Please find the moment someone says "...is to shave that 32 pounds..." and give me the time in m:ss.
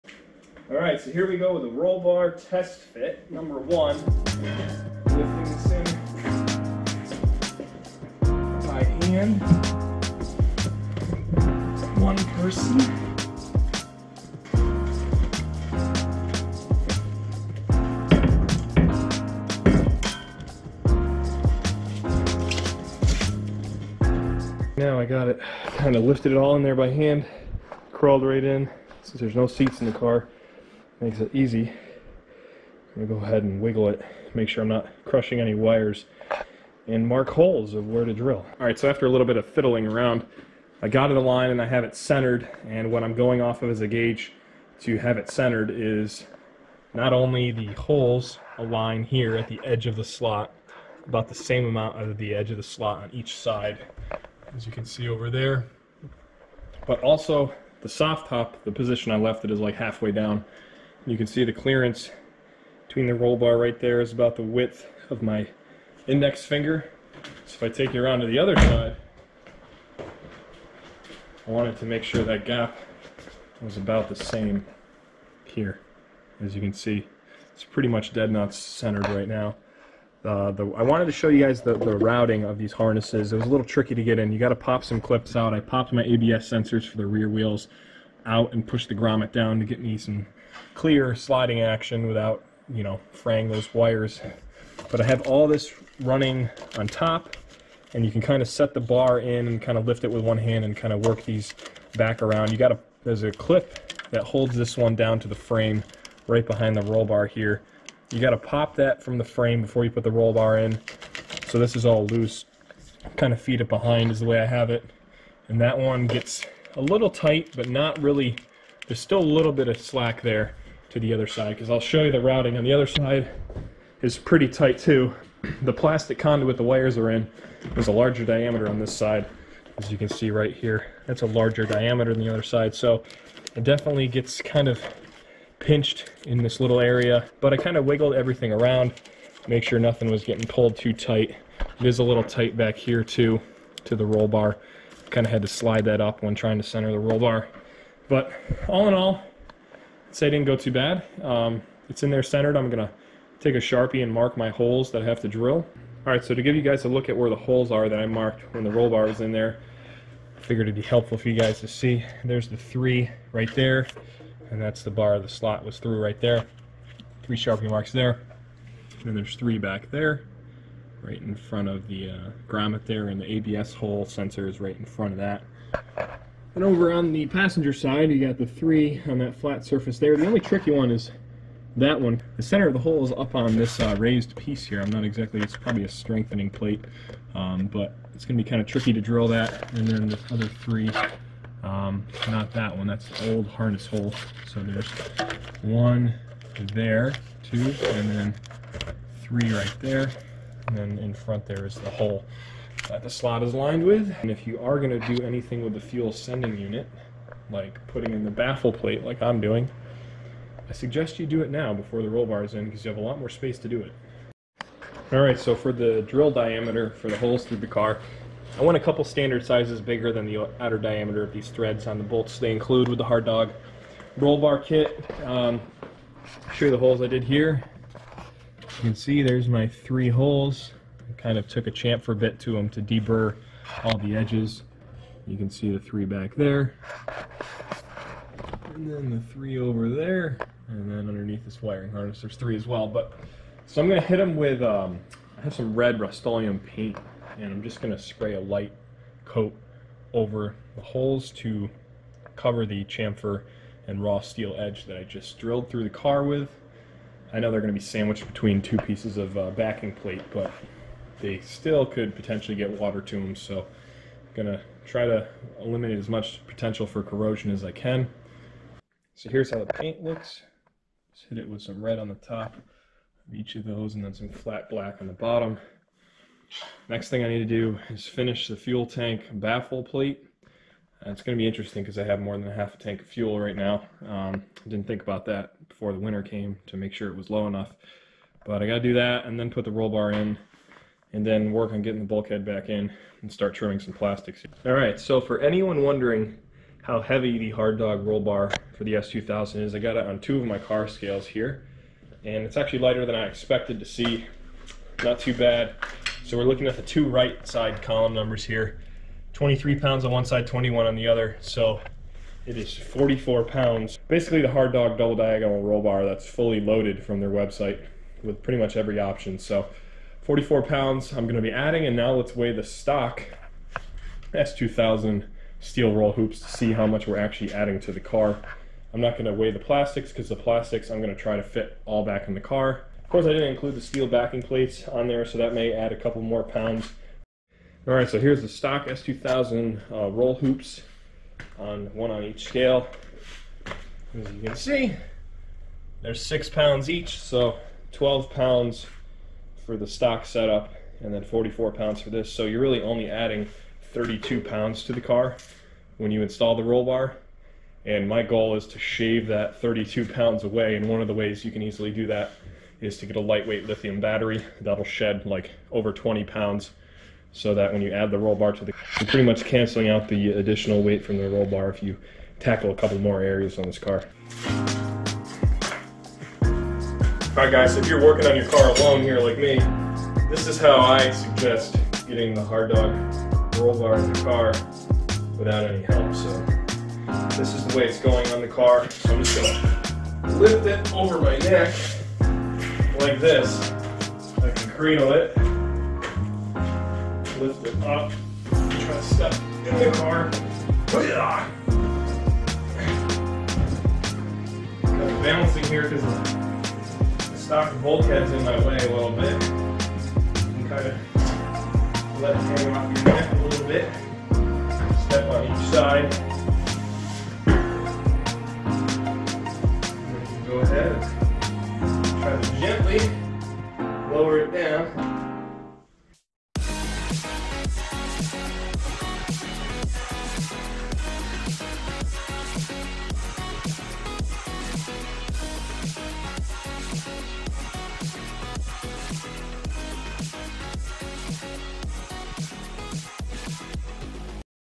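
5:58.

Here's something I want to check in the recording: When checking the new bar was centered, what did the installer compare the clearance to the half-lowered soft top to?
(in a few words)
index finger.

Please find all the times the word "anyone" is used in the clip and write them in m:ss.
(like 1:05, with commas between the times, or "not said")
4:55.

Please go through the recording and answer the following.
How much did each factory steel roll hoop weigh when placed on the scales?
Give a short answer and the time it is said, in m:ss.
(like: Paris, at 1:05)
6 pounds, at 5:46.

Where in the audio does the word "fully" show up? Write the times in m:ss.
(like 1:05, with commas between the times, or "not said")
5:16.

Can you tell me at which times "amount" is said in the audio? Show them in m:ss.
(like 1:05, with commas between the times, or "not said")
0:51.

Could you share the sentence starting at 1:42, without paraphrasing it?
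You got a, there's a clip that holds this one down to the frame right behind the roll bar here.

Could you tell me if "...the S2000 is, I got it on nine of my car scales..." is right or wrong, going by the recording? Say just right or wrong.
wrong.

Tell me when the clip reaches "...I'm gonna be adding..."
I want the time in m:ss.
5:21.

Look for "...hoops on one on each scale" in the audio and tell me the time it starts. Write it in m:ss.
5:40.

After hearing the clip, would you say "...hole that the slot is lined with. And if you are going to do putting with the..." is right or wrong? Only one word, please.
wrong.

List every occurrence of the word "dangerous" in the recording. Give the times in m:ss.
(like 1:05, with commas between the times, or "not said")
not said.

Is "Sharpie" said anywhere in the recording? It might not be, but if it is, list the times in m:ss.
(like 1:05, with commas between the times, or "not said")
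2:33, 2:47.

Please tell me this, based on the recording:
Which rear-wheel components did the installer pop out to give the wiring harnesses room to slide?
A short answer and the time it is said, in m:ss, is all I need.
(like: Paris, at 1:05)
ABS sensors, at 1:26.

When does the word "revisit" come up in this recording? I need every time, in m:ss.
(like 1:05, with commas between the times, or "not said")
not said.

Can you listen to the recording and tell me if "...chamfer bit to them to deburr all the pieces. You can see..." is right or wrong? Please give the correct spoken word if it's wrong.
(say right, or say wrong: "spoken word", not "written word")
wrong: "edges", not "pieces".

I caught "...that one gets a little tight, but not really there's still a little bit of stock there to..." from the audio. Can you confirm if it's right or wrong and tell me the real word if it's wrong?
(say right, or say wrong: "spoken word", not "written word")
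wrong: "slack", not "stock".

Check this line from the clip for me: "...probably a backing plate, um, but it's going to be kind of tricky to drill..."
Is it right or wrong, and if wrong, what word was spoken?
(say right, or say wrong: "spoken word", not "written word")
wrong: "strengthening", not "backing".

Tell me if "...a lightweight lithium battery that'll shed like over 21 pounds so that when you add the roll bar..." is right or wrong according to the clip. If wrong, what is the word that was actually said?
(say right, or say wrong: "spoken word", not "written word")
wrong: "20", not "21".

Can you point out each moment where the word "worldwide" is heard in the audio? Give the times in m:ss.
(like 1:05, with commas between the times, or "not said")
not said.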